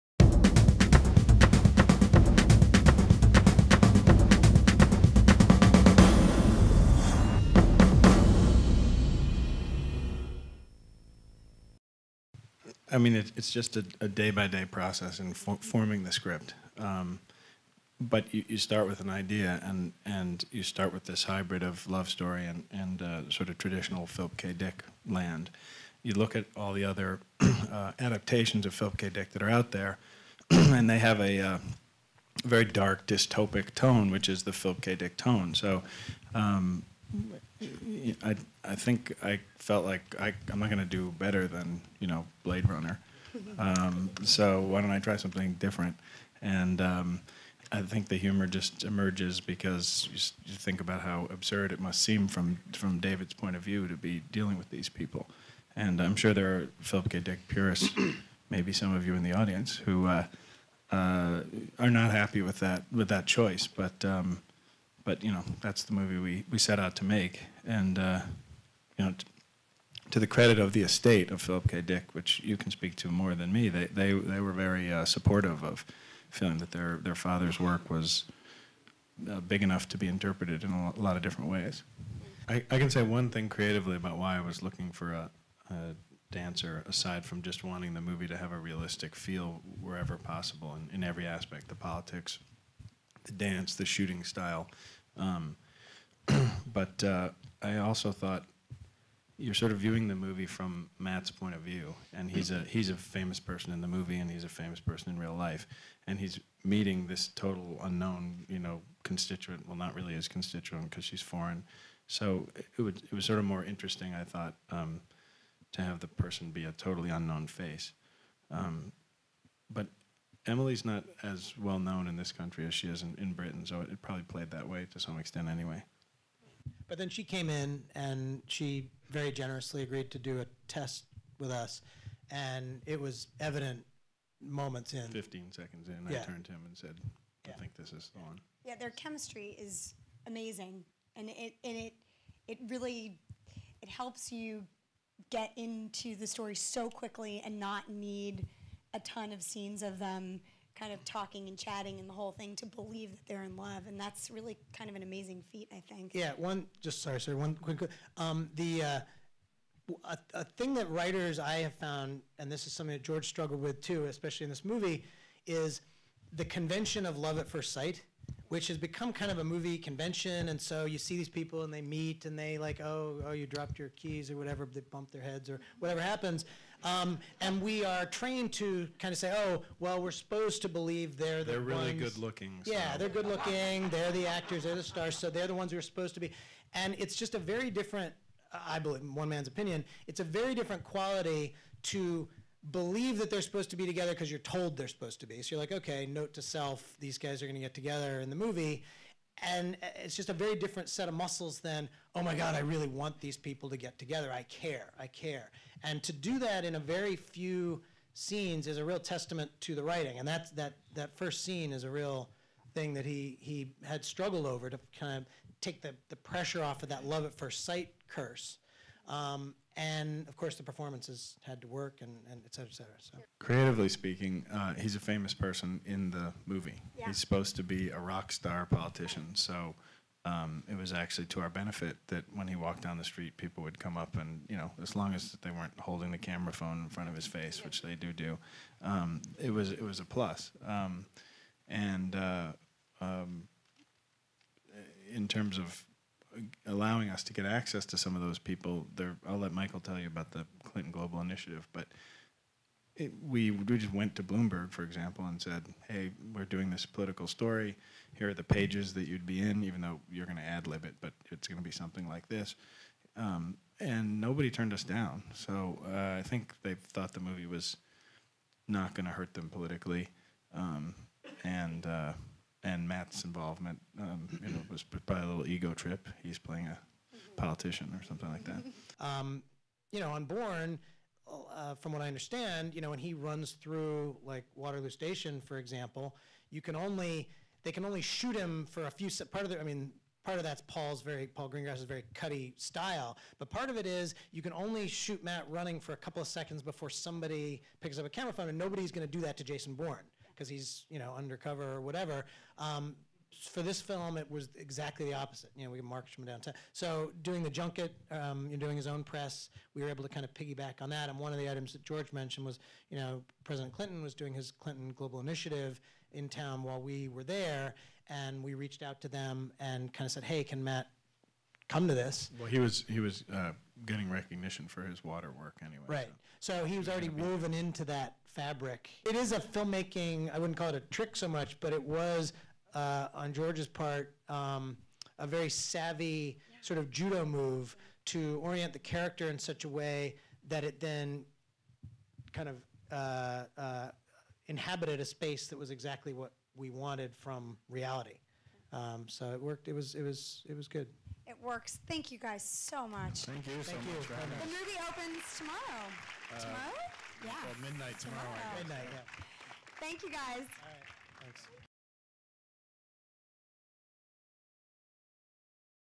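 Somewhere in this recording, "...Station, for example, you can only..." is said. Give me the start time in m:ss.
4:44.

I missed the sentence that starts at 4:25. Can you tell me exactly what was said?
So uh, I think they thought the movie was not going to hurt them politically, um, and.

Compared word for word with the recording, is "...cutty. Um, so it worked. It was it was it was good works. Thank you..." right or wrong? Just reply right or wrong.
wrong.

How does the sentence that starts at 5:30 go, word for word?
I wouldn't call it a trick so much, but it was uh, on George's part um, a very savvy yeah.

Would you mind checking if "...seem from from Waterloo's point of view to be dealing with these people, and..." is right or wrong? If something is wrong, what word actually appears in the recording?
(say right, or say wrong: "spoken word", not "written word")
wrong: "David", not "Waterloo".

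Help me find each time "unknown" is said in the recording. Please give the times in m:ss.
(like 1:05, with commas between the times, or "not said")
1:47, 1:57.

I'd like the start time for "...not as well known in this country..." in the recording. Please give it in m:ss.
2:00.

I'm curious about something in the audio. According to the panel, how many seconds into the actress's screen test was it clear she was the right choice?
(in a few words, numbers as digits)
15.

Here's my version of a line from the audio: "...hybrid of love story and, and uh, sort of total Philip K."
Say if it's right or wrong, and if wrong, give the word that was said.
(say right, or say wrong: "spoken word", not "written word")
wrong: "traditional", not "total".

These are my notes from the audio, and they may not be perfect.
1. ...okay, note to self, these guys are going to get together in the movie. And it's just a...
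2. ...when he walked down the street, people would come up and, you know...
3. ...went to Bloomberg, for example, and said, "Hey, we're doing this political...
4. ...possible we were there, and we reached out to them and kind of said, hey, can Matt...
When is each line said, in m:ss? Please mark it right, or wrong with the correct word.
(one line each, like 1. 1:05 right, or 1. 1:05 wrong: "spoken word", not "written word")
1. 3:15 right
2. 3:52 right
3. 4:13 right
4. 5:16 wrong: "while", not "possible".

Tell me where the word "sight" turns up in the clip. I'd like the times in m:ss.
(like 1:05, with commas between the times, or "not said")
2:47, 3:37.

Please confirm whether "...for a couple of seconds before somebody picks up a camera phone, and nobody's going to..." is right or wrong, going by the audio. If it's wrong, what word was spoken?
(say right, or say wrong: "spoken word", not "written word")
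right.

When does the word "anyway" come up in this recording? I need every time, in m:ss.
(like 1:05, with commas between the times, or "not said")
2:05, 5:25.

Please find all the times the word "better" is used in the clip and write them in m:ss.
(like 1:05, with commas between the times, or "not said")
0:41.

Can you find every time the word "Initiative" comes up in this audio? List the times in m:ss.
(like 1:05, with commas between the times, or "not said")
4:11, 5:15.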